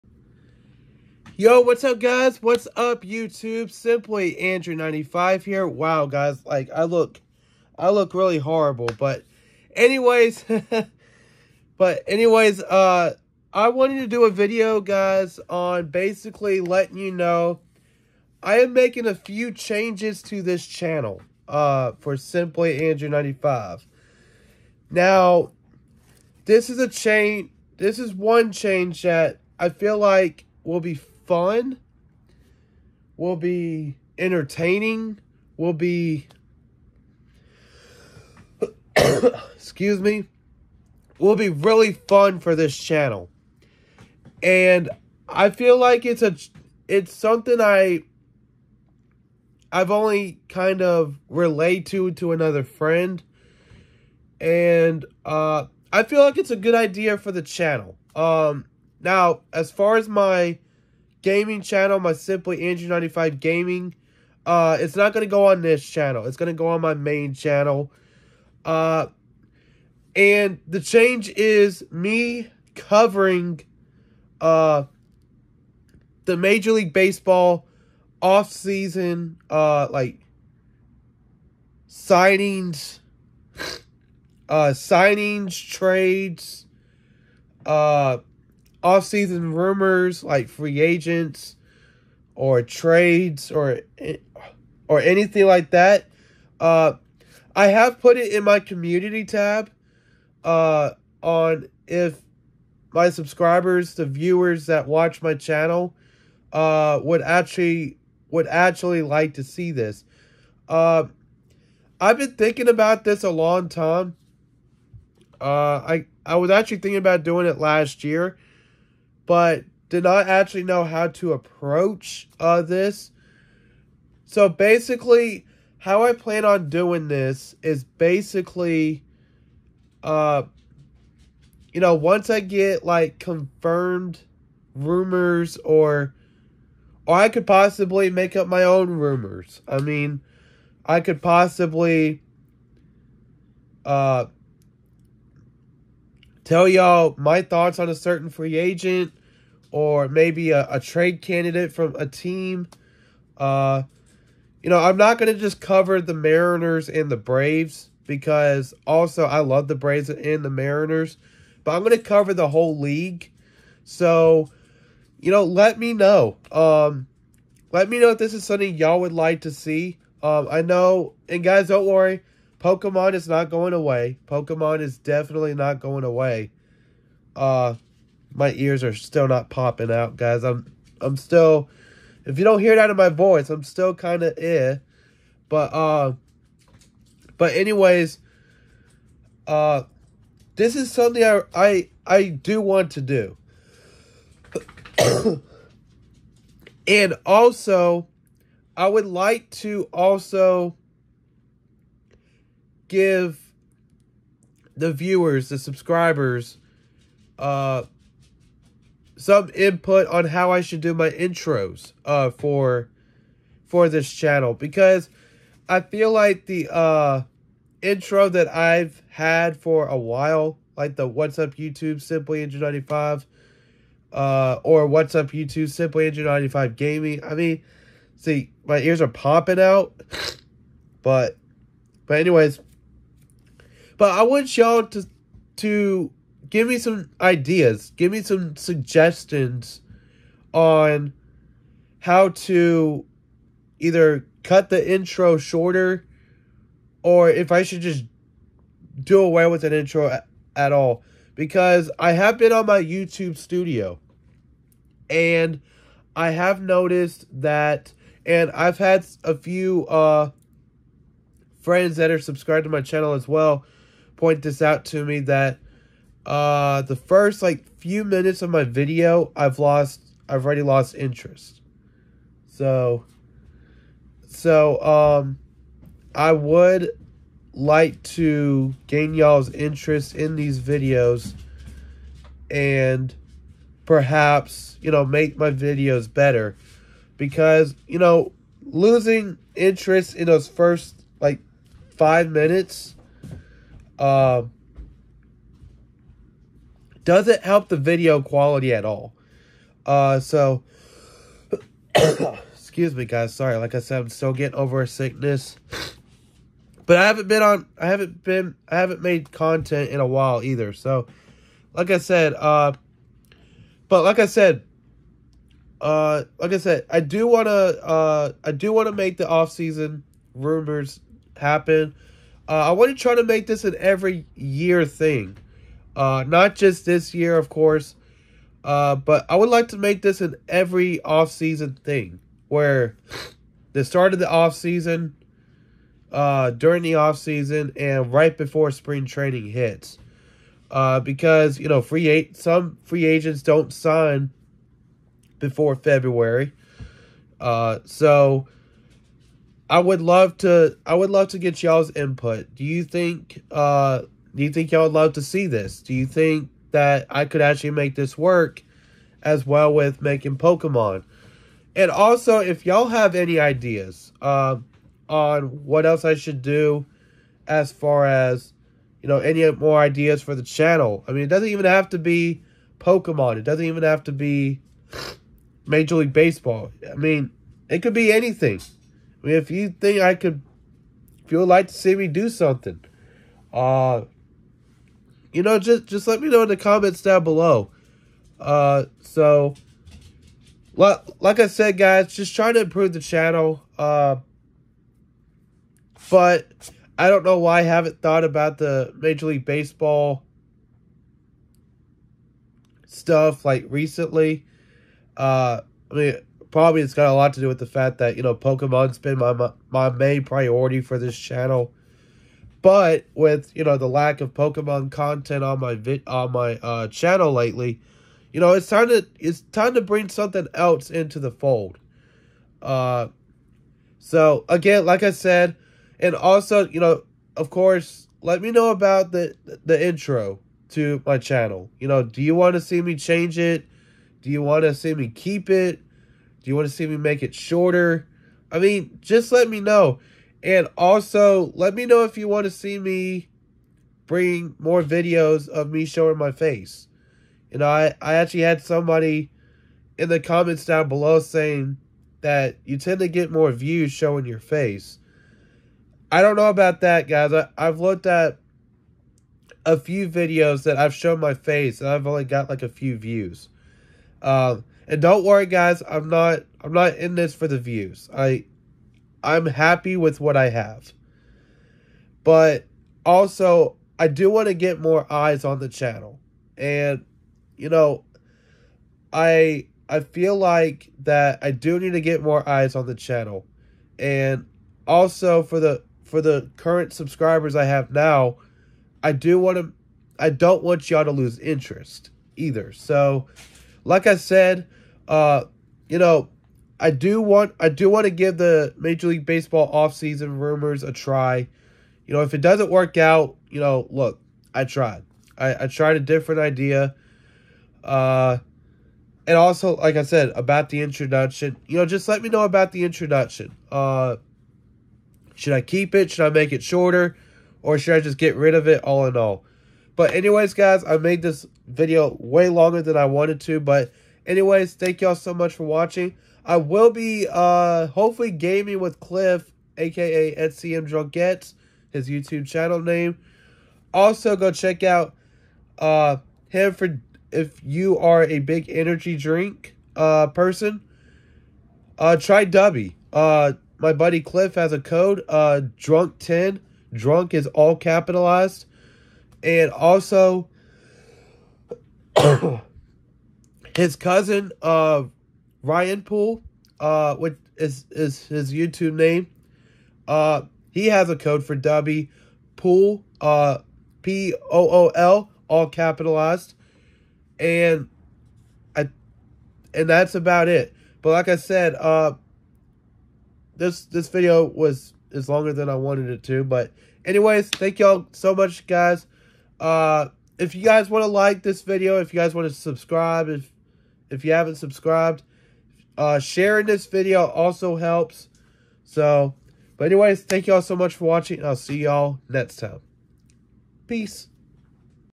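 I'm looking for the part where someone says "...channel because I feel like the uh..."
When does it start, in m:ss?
3:34.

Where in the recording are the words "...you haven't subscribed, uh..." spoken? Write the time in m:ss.
9:44.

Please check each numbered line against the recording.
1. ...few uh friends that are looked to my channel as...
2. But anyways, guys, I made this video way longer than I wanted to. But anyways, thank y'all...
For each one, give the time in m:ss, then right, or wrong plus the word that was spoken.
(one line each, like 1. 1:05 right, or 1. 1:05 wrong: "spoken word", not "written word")
1. 4:19 wrong: "subscribed", not "looked"
2. 8:39 right.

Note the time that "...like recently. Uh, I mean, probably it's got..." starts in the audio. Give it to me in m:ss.
6:43.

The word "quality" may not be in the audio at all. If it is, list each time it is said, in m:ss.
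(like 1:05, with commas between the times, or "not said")
4:58.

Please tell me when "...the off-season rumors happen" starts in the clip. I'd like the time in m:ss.
5:19.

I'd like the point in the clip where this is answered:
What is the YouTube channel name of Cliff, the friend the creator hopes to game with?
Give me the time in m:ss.
8:50.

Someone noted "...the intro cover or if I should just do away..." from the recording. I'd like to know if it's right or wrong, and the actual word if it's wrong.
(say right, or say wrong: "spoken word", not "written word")
wrong: "shorter", not "cover".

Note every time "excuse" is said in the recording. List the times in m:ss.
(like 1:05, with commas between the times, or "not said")
0:39, 5:02.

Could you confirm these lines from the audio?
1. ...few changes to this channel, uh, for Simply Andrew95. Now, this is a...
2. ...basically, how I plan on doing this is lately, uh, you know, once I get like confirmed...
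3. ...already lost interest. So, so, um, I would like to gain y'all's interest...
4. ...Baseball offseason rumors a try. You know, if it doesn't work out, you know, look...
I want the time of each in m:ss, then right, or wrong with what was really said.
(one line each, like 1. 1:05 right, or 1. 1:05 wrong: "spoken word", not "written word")
1. 0:19 right
2. 2:04 wrong: "basically", not "lately"
3. 4:30 right
4. 8:19 right.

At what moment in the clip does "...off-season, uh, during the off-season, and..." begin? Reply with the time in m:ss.
5:34.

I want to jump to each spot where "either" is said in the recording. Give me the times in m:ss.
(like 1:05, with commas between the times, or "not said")
4:03, 5:10, 8:12.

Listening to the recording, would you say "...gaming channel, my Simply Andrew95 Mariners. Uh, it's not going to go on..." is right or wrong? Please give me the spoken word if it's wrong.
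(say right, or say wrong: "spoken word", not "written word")
wrong: "Gaming", not "Mariners".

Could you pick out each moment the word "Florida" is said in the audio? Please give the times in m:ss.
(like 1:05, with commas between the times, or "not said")
not said.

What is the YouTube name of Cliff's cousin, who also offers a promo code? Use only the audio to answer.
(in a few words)
Ryan Pool.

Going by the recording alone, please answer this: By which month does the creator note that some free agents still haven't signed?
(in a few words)
February.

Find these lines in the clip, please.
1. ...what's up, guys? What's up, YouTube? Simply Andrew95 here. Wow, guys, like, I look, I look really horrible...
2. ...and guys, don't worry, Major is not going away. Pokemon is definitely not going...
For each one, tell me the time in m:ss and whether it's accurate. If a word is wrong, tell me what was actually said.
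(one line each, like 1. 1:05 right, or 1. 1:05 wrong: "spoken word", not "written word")
1. 0:01 right
2. 2:51 wrong: "Pokemon", not "Major".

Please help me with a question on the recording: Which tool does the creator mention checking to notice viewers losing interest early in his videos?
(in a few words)
YouTube studio.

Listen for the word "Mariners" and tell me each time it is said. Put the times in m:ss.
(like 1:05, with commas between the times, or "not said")
2:36, 2:40.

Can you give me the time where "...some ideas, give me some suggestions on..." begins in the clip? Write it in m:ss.
3:56.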